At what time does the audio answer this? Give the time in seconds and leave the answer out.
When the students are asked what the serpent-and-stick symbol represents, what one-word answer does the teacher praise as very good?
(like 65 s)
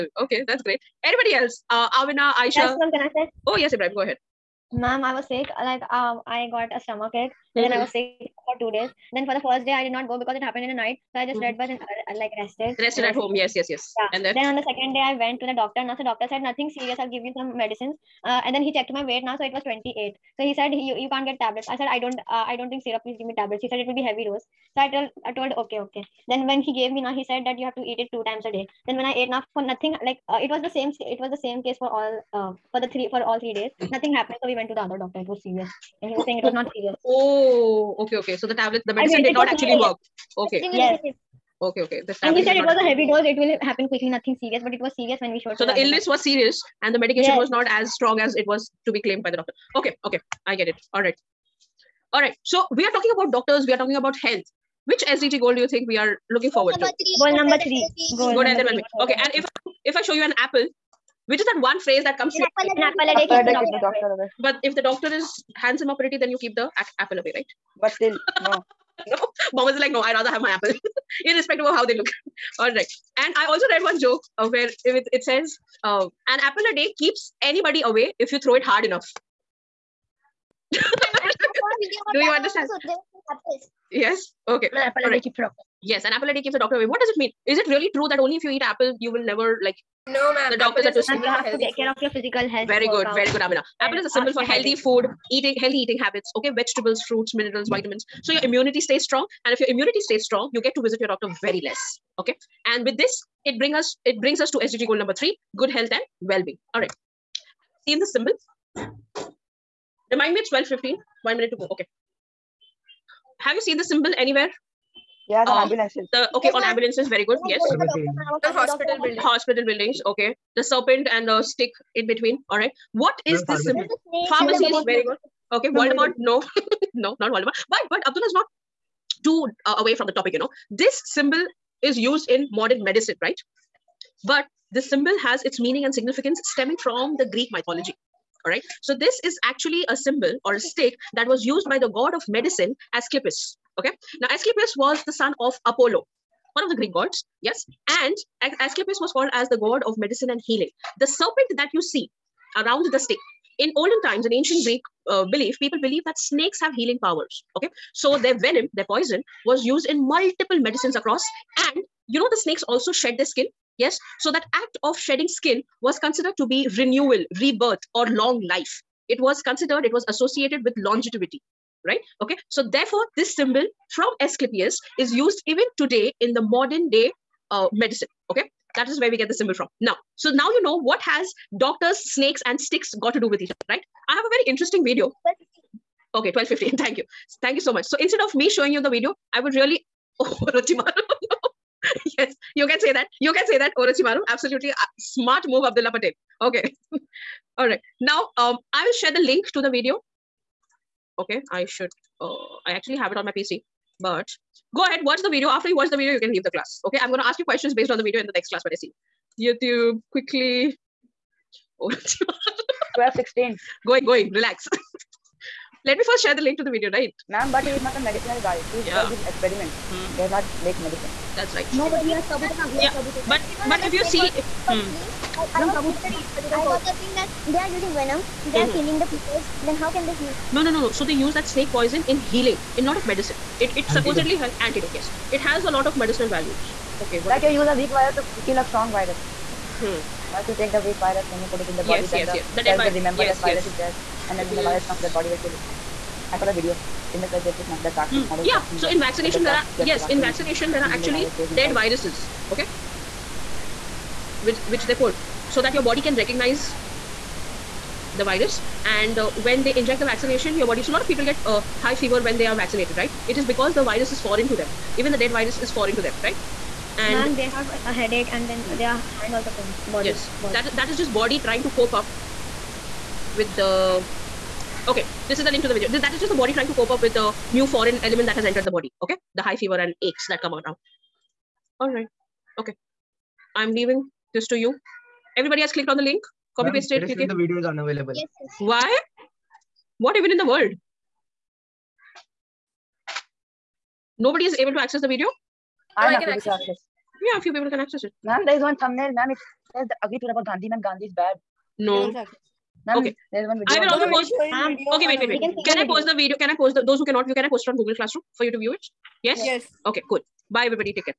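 124 s.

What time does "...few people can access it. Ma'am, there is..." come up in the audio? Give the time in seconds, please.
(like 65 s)
297 s.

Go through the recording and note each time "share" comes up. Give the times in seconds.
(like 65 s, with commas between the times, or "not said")
198 s, 216 s.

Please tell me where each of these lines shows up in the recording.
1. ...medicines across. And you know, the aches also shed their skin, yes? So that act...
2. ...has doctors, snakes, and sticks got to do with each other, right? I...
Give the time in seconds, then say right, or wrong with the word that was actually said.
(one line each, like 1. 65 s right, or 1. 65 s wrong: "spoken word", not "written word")
1. 160 s wrong: "snakes", not "aches"
2. 181 s right.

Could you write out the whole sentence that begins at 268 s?
their hand also pains body yes body.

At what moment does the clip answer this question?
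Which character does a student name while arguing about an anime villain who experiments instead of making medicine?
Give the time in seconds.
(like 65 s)
222 s.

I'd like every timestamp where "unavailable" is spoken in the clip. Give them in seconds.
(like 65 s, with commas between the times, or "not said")
287 s.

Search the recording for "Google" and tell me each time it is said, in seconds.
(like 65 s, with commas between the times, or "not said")
307 s.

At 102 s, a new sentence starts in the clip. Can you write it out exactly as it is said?
Okay, and with this, it brings us it brings us to SDG goal number three: good health and well-being.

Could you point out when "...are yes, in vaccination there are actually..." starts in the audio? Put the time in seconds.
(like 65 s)
249 s.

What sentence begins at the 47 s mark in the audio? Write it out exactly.
was not as strong as it was to be claimed by the doctor.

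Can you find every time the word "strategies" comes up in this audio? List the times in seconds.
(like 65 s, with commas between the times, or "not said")
not said.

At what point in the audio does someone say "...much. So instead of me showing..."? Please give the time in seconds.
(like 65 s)
187 s.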